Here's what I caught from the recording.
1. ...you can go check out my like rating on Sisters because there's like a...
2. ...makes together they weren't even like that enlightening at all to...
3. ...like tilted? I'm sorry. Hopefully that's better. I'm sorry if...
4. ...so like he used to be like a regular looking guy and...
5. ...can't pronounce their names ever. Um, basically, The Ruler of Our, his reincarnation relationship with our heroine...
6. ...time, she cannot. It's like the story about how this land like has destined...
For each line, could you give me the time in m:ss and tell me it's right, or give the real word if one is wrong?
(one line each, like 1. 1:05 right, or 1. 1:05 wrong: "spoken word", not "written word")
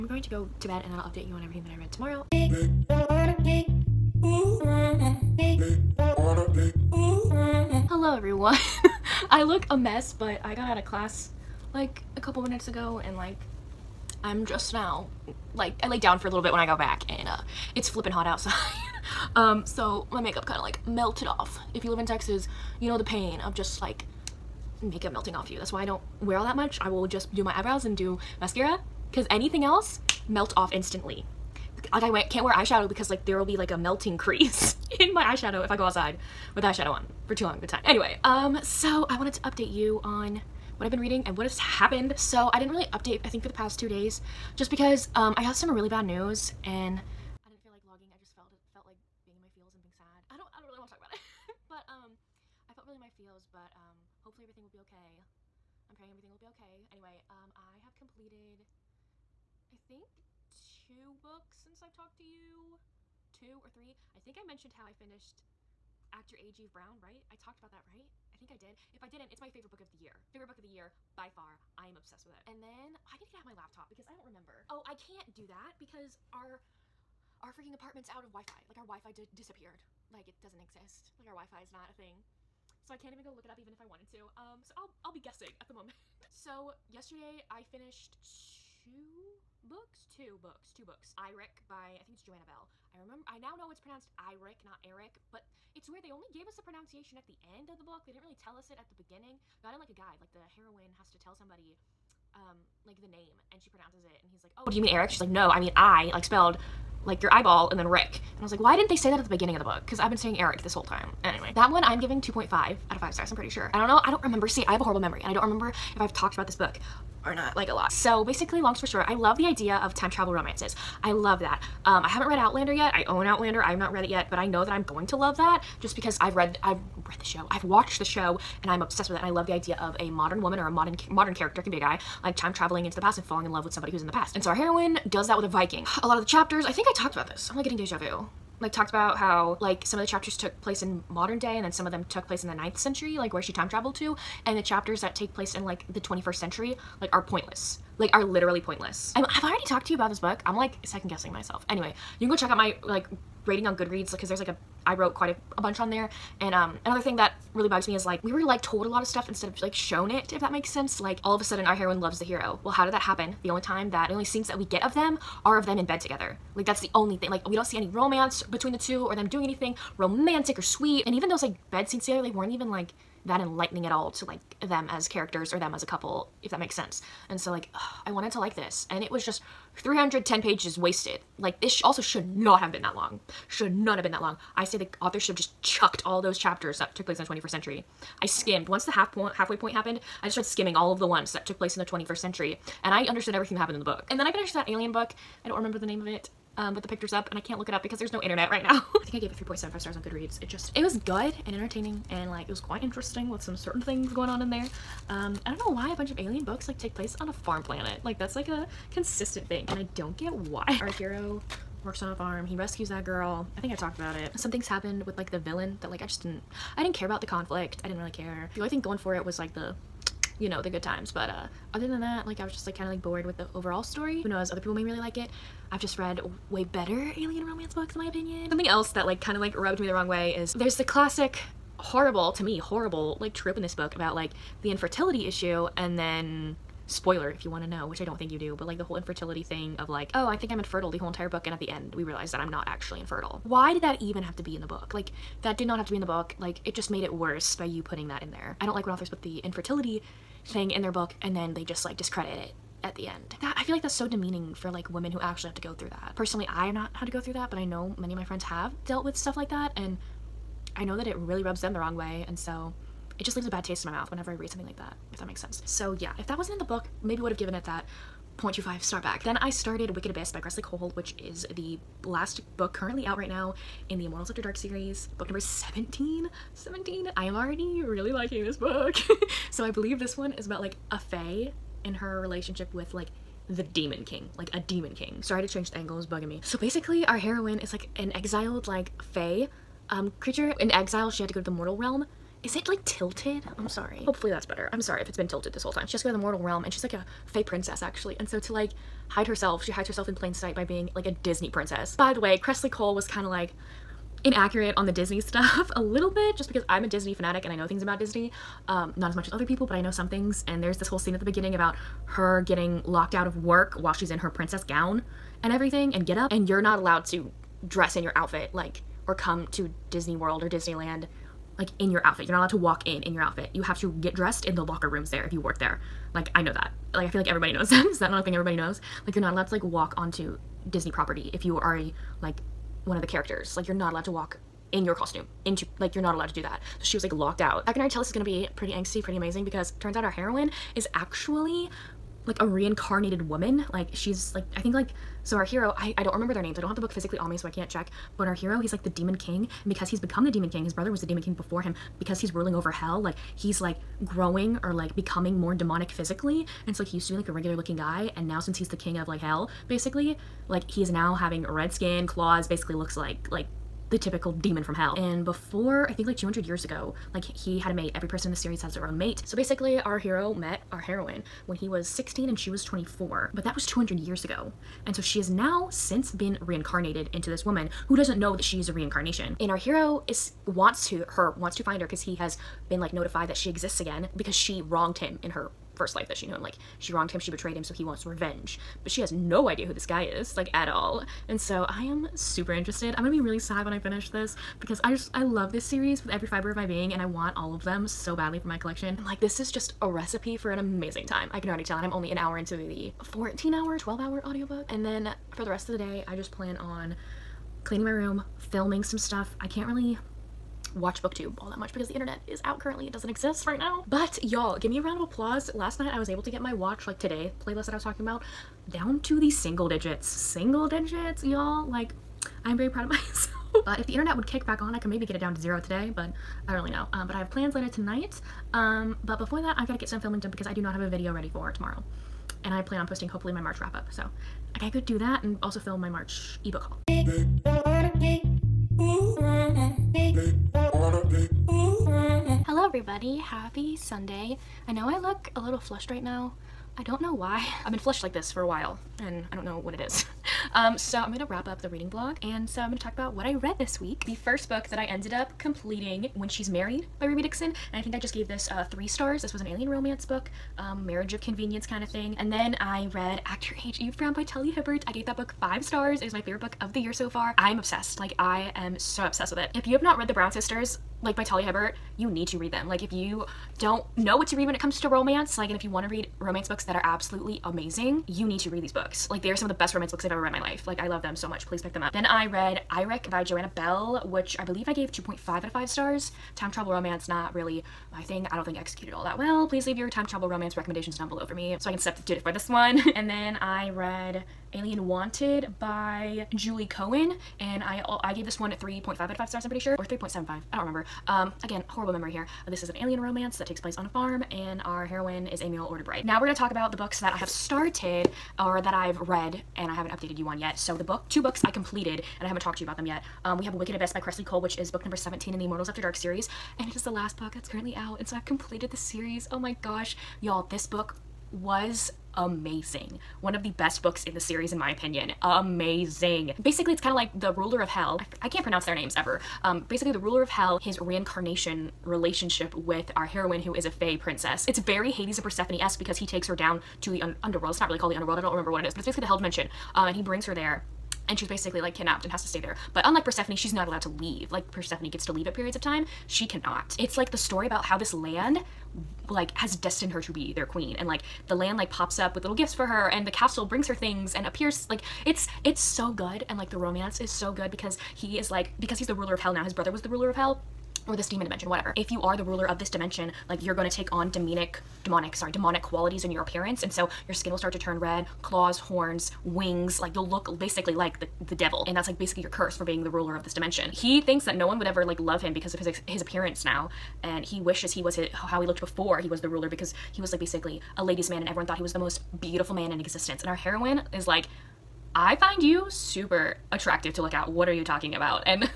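1. 2:32 wrong: "Goodreads", not "Sisters"
2. 2:51 wrong: "scenes", not "makes"
3. 4:52 right
4. 5:56 right
5. 8:48 wrong: "Hell", not "Our"
6. 9:05 right.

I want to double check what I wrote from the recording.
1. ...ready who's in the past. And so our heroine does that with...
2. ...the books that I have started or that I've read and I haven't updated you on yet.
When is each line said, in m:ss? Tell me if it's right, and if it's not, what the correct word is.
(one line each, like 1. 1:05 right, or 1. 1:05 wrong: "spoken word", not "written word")
1. 2:13 wrong: "somebody", not "ready"
2. 8:26 right.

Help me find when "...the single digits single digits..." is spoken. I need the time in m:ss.
6:59.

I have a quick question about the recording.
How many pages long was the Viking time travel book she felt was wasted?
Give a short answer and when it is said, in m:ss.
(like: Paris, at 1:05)
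310, at 2:59.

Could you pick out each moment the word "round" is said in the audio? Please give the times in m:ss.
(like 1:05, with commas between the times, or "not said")
6:54.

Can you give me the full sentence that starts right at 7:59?
Like, they are some of the best romance books I've ever read in my life.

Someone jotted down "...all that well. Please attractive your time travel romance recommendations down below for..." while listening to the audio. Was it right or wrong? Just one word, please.
wrong.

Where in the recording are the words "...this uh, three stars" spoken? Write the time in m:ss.
7:38.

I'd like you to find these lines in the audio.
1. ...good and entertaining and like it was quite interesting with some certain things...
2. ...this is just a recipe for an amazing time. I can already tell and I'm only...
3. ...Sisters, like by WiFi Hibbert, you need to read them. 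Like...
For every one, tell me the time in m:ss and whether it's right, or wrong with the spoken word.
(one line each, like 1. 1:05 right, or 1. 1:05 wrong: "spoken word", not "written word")
1. 3:20 right
2. 6:39 right
3. 7:50 wrong: "Talia", not "WiFi".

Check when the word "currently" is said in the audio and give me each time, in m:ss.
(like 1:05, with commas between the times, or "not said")
4:32, 6:52, 8:37.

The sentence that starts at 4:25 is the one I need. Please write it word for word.
So yeah, if that wasn't in the book, maybe would have given it that 0.25 star back.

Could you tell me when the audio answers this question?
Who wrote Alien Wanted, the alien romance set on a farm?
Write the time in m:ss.
8:16.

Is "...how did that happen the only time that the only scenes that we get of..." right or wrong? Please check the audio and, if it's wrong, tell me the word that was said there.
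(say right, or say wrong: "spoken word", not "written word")
right.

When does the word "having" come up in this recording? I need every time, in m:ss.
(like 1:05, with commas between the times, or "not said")
6:01.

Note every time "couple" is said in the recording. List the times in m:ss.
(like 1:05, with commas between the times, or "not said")
0:12, 2:55.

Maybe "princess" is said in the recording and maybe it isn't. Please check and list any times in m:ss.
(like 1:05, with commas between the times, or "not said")
4:57, 5:01, 5:14, 8:53.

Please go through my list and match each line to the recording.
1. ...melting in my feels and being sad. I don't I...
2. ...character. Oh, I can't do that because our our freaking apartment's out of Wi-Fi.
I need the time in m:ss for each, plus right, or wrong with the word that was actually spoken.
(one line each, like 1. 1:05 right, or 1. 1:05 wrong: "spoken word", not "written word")
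1. 0:49 wrong: "being", not "melting"
2. 1:14 wrong: "remember", not "character".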